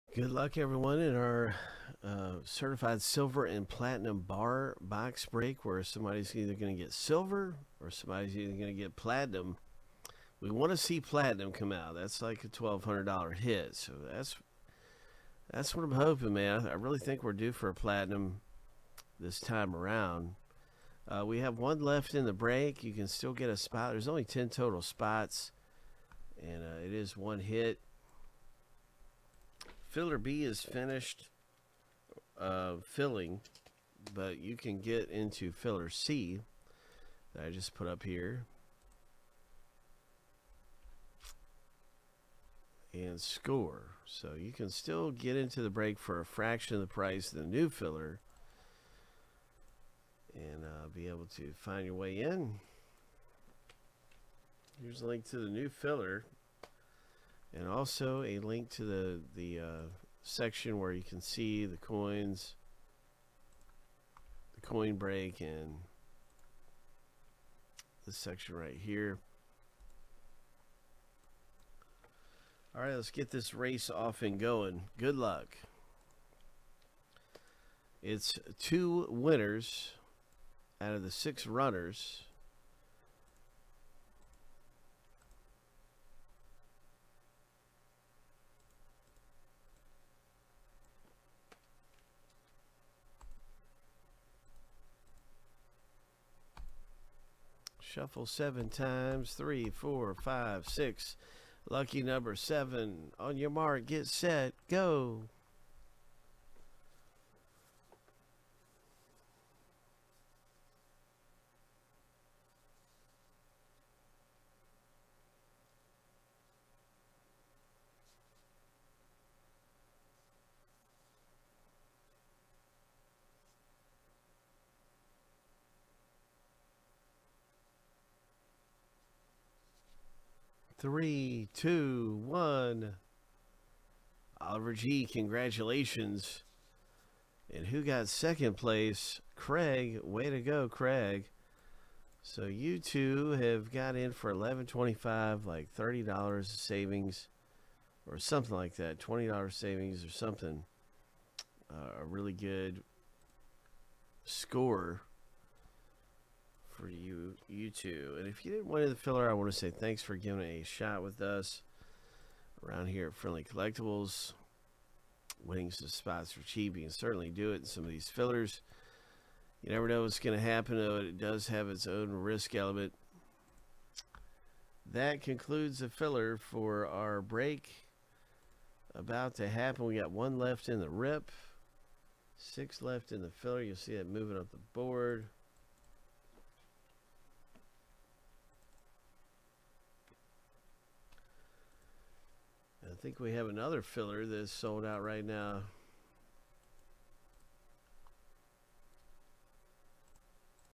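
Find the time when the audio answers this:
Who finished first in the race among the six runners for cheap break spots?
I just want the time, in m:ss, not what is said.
2:14.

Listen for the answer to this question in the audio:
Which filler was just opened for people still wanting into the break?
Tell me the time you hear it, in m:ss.
0:35.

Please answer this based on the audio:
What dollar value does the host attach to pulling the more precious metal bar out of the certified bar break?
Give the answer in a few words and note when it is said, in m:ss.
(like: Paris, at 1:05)
$1,200, at 0:12.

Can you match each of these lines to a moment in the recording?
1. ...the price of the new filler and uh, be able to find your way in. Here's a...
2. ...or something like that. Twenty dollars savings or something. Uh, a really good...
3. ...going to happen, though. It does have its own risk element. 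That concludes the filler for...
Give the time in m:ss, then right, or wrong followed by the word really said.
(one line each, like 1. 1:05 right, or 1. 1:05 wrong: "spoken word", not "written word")
1. 0:46 right
2. 2:28 right
3. 2:50 right.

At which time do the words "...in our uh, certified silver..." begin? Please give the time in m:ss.
0:00.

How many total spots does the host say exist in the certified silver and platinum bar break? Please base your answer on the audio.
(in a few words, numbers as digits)
10.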